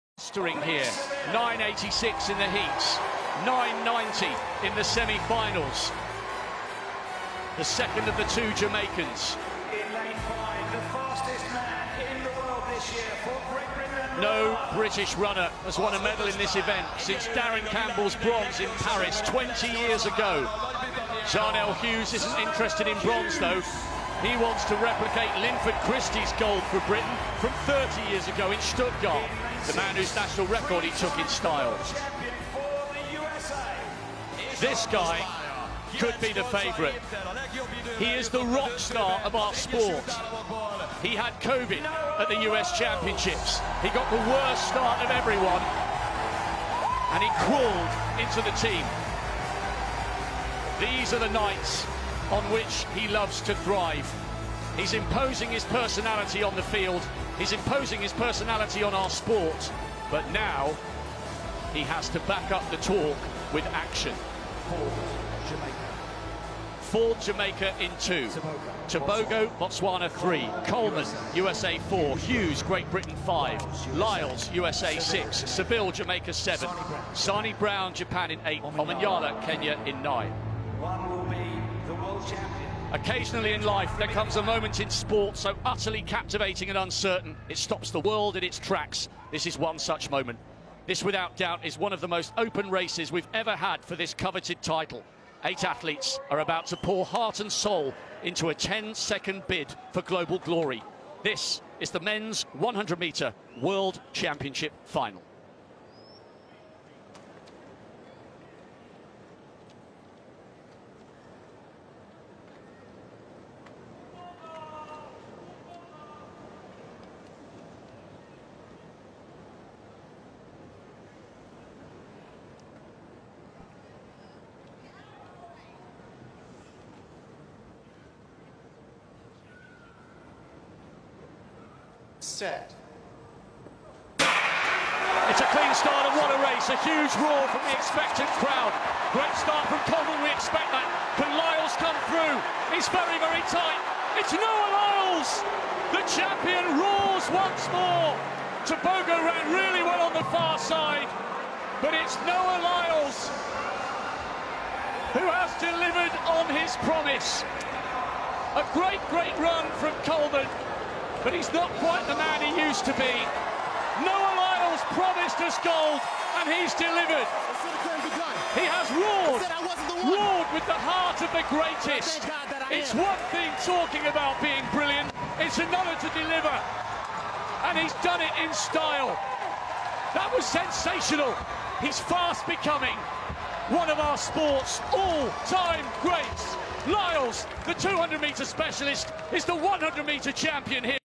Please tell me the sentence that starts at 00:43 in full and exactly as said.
He got the worst start of everyone.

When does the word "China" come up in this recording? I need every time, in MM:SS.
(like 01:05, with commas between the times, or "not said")
not said.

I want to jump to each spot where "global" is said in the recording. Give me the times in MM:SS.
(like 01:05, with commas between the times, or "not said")
01:40.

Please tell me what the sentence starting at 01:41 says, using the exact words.
This is the men's 100-metre World Championship final.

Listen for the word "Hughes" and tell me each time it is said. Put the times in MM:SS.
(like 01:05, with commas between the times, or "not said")
00:21, 01:12.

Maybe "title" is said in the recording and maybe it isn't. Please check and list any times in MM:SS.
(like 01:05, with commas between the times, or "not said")
01:34.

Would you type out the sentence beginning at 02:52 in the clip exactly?
It's one thing talking about being brilliant, it's another to deliver.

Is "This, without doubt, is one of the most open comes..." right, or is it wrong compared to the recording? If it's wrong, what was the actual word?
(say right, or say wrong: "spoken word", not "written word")
wrong: "races", not "comes".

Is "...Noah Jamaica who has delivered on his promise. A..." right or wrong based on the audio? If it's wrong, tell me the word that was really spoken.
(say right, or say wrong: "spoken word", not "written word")
wrong: "Lyles", not "Jamaica".